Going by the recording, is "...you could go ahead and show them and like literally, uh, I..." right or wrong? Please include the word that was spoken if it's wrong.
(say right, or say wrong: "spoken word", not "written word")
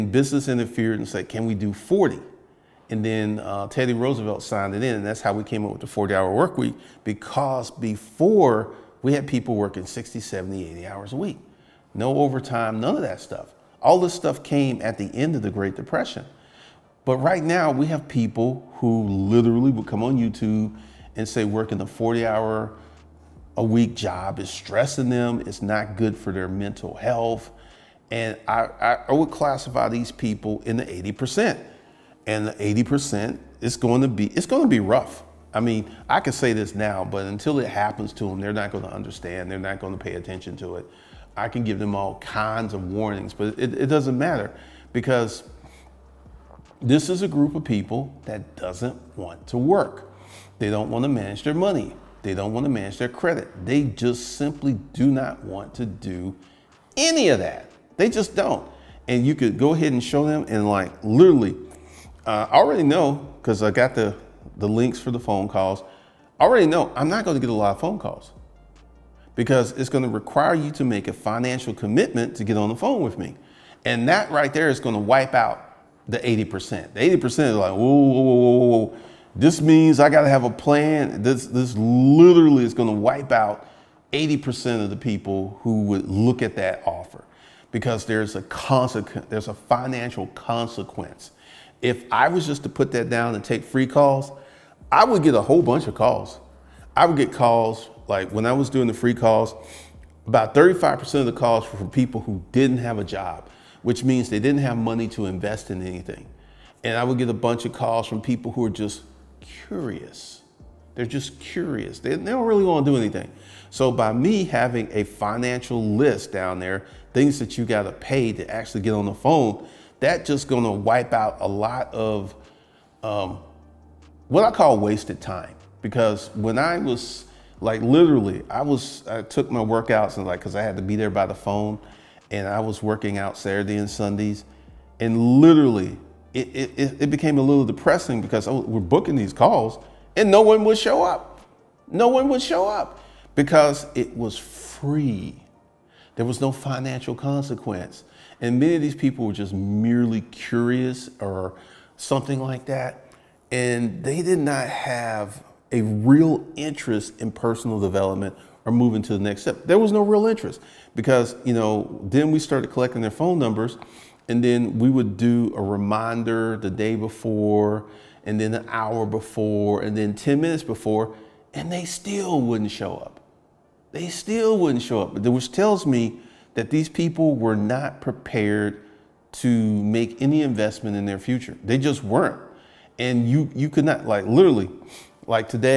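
right.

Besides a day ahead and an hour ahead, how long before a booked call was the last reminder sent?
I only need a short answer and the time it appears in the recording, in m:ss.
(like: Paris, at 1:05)
10 minutes, at 2:50.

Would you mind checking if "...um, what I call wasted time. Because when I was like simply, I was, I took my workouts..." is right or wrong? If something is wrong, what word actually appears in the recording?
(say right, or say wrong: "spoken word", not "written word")
wrong: "literally", not "simply".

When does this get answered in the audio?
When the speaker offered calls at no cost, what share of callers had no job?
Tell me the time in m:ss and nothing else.
1:40.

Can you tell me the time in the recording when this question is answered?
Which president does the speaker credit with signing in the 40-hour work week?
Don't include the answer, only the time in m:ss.
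0:03.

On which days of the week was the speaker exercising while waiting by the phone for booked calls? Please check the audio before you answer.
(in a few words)
Saturday and Sundays.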